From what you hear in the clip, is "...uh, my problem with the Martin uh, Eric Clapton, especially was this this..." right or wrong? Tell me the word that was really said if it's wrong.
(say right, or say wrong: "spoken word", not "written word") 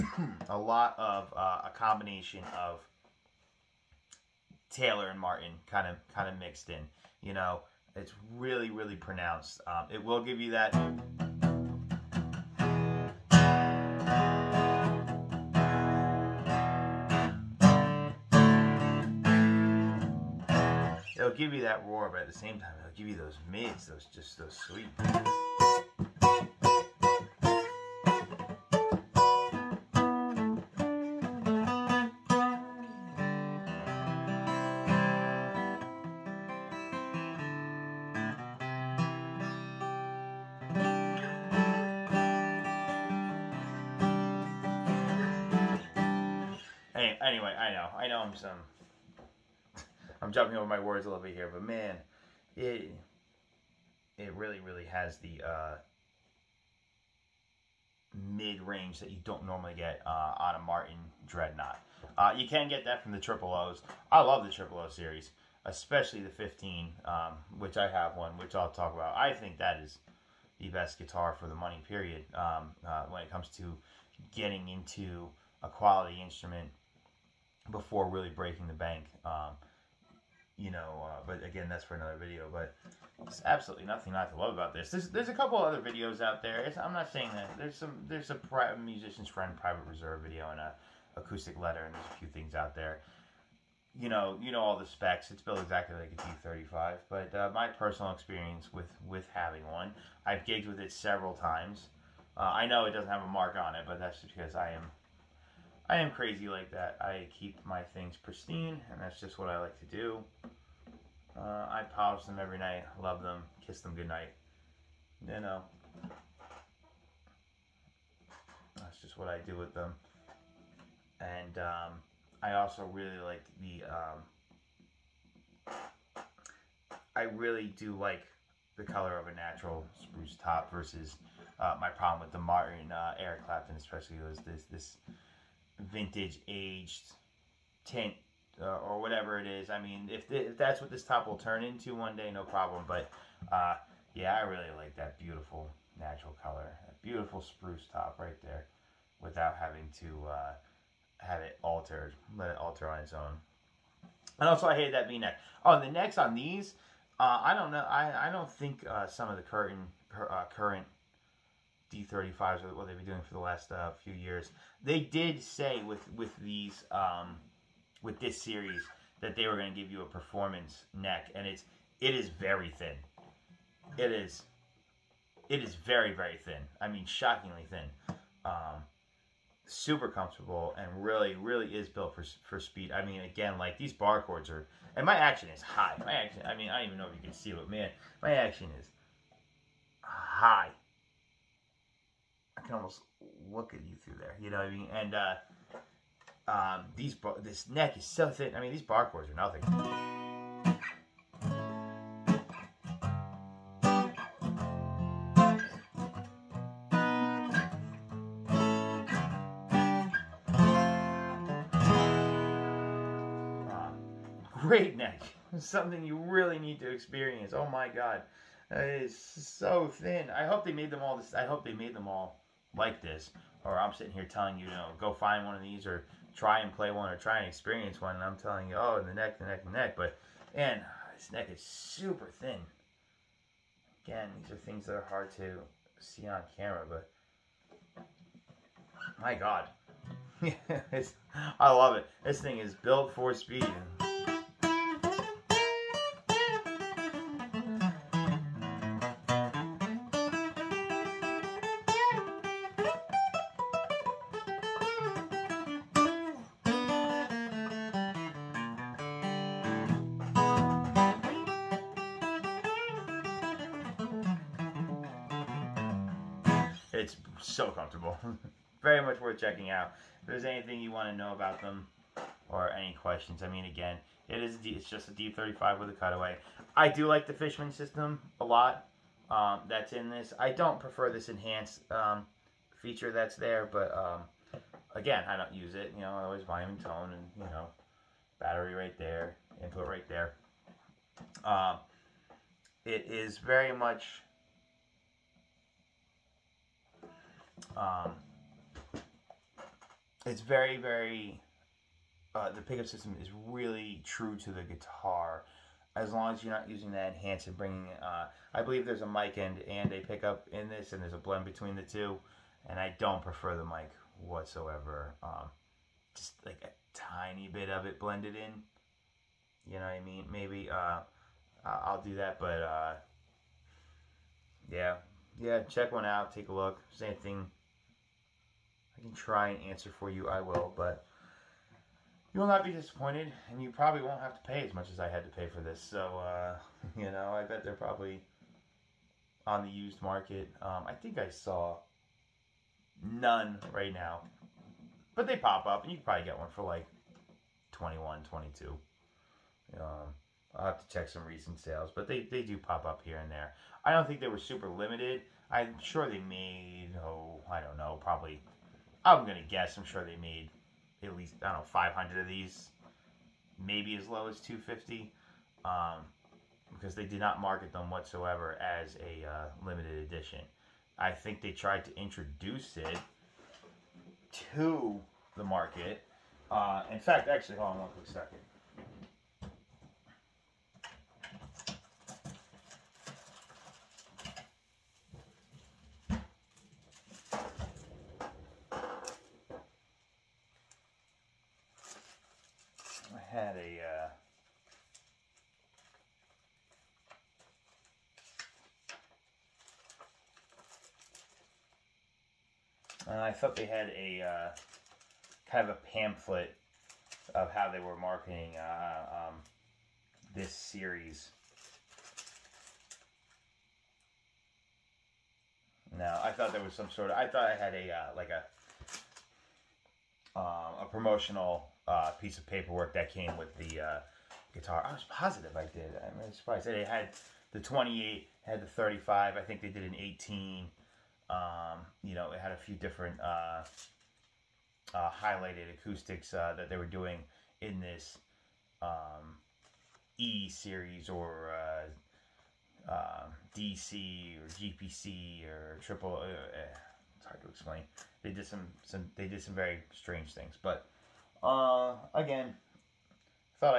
right.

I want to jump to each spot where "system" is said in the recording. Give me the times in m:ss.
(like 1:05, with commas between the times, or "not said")
4:37, 5:02.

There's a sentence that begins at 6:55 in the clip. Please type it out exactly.
No, I thought there was some sort of.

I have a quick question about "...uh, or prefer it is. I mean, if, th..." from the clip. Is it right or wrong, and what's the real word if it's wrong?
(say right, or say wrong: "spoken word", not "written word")
wrong: "whatever", not "prefer".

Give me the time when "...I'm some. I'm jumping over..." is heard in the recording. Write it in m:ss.
0:48.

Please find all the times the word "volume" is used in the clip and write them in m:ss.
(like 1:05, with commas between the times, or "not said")
4:46.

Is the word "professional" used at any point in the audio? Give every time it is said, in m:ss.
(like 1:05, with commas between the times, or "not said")
not said.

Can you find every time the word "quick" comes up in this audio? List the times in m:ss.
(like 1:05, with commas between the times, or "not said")
6:17.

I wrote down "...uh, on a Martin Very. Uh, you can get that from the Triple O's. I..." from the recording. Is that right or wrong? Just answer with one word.
wrong.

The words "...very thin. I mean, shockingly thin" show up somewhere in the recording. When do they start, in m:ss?
2:56.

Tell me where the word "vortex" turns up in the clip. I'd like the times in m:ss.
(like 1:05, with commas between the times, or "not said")
not said.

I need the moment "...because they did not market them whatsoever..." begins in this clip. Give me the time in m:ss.
6:06.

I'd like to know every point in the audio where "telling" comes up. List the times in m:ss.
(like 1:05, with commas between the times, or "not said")
3:44, 3:48.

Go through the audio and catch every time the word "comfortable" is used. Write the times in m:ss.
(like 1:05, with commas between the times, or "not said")
3:00, 4:27.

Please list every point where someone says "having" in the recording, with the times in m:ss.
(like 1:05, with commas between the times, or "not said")
1:39, 2:29.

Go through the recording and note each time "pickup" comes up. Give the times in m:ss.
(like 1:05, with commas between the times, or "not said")
5:02, 5:09.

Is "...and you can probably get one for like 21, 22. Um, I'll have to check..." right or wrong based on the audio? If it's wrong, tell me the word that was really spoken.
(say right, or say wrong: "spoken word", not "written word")
right.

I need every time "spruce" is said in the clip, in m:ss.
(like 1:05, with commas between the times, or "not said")
2:10, 2:27.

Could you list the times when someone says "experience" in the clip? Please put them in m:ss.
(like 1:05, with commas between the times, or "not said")
1:38, 3:36, 3:47.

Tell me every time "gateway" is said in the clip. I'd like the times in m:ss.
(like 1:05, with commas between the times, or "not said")
not said.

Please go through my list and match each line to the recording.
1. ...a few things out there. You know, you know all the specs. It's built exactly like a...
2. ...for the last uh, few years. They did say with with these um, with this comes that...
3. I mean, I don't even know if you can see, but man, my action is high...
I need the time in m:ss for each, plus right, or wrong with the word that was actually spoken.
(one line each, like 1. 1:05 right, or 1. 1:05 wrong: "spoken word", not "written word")
1. 1:32 right
2. 2:43 wrong: "series", not "comes"
3. 3:06 right.